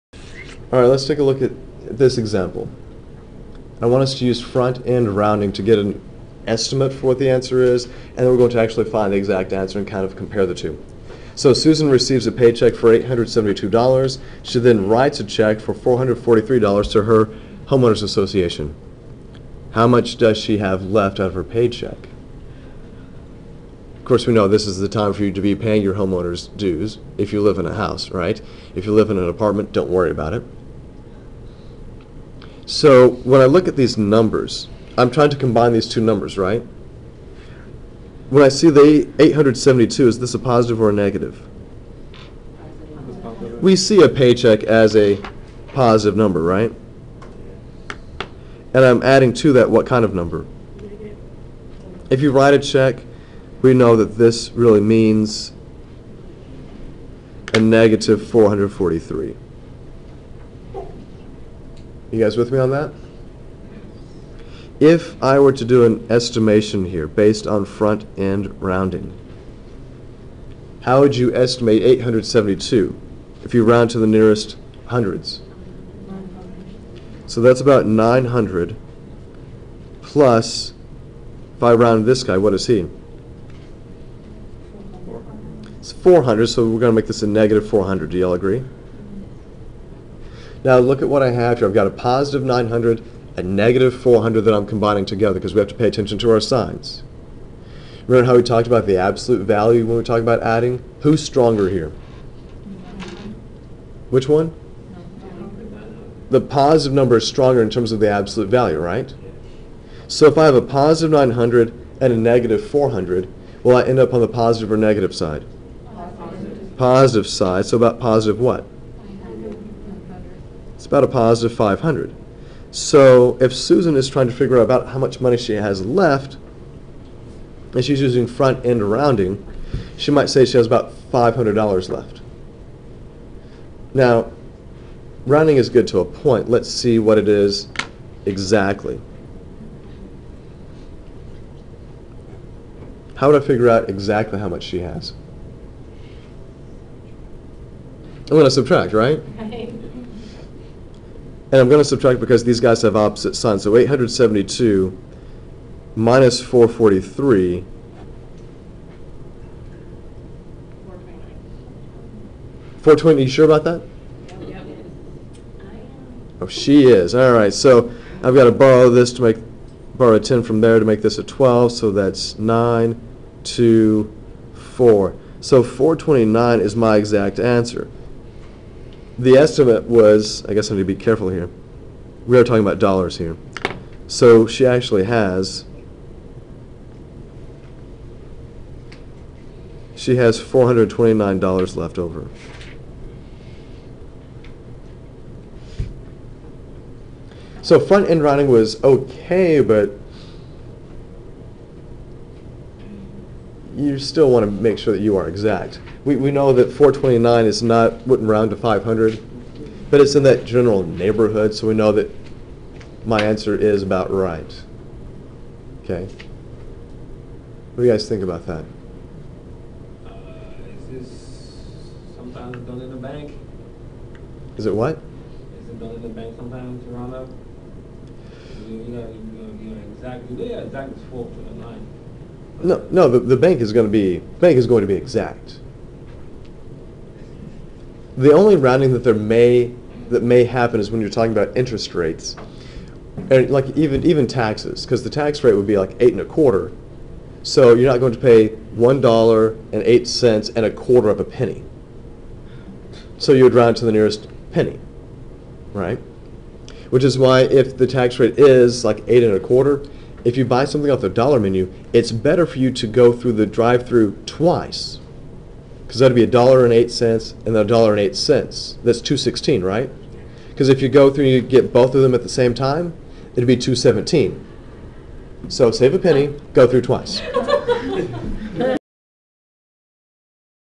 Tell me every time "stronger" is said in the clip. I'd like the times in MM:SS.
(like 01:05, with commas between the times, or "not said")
01:41, 01:47.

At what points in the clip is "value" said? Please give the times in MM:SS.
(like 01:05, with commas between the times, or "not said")
01:39, 01:48.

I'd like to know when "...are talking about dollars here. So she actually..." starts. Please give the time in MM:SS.
03:02.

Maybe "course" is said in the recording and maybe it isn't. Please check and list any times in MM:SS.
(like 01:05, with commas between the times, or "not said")
00:24.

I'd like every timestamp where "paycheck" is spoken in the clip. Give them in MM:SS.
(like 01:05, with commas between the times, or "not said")
00:12, 00:21, 00:44.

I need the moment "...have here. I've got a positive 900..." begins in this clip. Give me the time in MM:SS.
01:31.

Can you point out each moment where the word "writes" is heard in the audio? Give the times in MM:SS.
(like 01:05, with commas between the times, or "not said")
00:14, 00:52.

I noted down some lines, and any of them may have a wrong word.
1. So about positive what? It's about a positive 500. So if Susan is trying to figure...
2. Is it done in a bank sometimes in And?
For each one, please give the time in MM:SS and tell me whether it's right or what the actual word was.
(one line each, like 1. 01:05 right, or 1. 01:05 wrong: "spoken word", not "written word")
1. 01:57 right
2. 03:45 wrong: "Toronto", not "And".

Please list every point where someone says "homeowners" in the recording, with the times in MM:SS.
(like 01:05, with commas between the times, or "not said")
00:17, 00:25.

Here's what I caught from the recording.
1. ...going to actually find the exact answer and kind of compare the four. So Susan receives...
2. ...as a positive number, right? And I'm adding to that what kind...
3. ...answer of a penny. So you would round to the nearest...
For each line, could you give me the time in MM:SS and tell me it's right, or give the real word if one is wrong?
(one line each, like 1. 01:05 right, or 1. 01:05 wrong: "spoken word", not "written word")
1. 00:08 wrong: "two", not "four"
2. 00:44 right
3. 04:10 wrong: "quarter", not "answer".